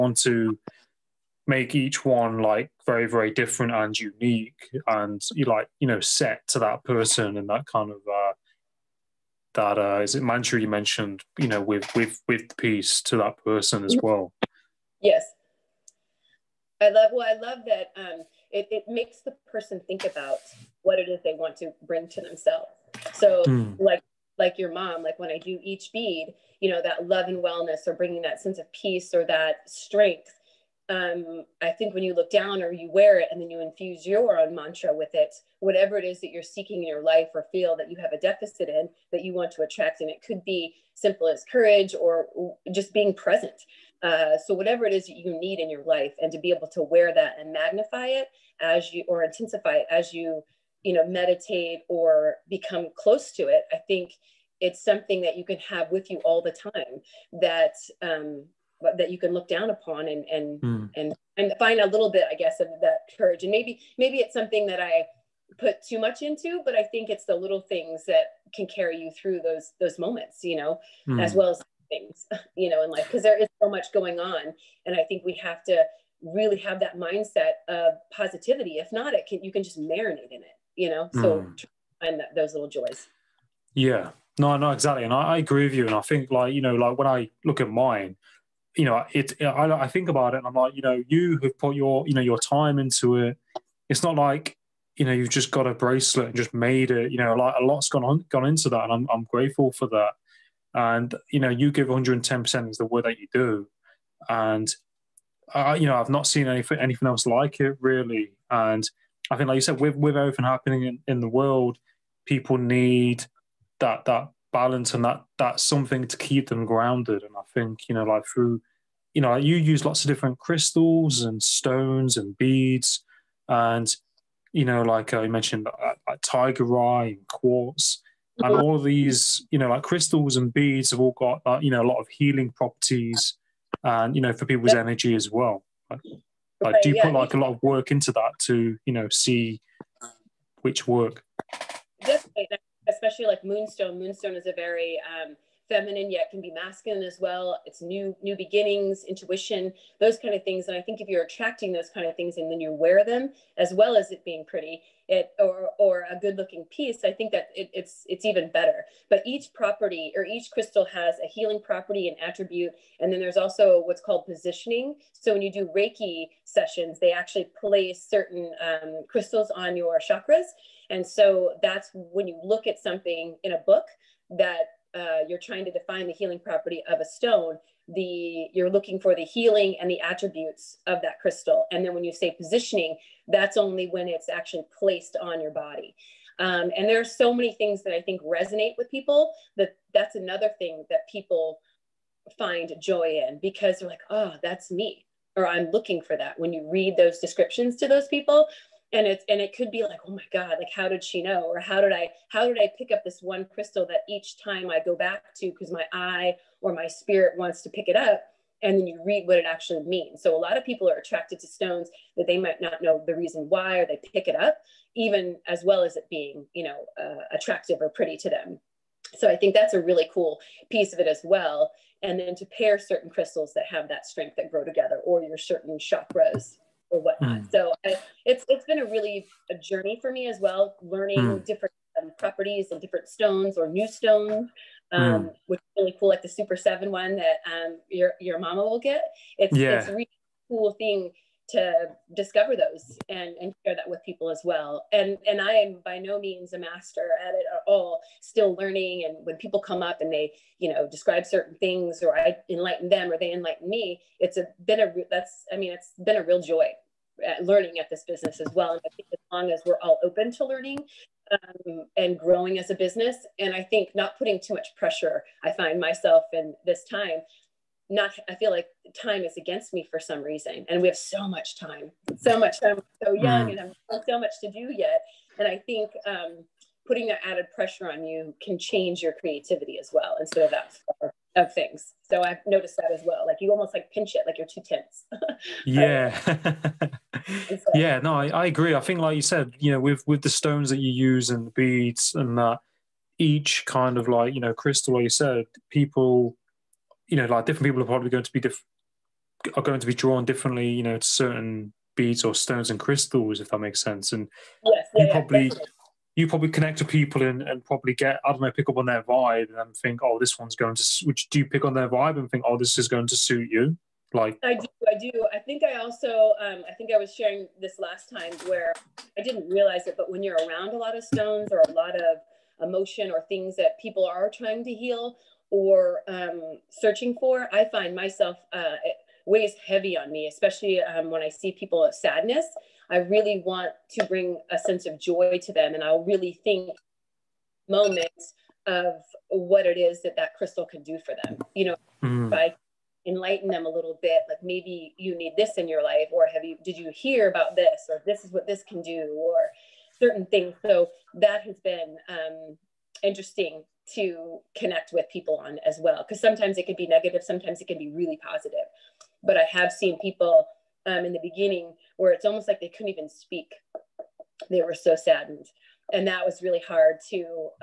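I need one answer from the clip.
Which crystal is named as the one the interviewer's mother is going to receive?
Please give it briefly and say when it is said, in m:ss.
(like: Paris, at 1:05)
Super Seven, at 3:56.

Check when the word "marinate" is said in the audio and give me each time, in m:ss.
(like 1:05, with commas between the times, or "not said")
1:19.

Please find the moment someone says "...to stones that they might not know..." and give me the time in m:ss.
3:31.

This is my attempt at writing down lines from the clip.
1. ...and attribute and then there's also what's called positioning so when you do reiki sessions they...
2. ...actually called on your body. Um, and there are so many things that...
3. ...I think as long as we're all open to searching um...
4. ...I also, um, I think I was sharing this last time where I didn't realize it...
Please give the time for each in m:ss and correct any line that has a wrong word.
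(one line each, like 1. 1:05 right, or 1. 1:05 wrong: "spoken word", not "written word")
1. 2:42 right
2. 3:04 wrong: "placed", not "called"
3. 4:18 wrong: "learning", not "searching"
4. 5:15 right.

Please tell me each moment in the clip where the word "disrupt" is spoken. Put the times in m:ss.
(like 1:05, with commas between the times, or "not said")
not said.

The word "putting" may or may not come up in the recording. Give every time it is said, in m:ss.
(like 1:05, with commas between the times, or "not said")
4:24, 4:36.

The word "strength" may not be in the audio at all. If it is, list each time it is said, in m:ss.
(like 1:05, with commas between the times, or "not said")
0:29, 3:44.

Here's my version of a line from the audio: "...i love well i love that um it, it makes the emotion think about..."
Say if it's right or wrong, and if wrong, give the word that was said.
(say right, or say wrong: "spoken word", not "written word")
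wrong: "person", not "emotion".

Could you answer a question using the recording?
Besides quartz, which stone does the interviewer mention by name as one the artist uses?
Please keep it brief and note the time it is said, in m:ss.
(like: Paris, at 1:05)
Tiger eye, at 2:06.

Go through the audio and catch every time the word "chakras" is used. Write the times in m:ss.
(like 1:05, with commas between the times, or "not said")
2:50, 3:45.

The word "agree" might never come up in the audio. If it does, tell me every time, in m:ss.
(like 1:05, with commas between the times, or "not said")
1:25, 4:48.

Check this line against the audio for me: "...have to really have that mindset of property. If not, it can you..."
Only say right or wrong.
wrong.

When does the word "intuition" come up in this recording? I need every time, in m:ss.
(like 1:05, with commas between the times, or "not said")
2:29.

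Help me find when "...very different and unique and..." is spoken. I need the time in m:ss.
0:03.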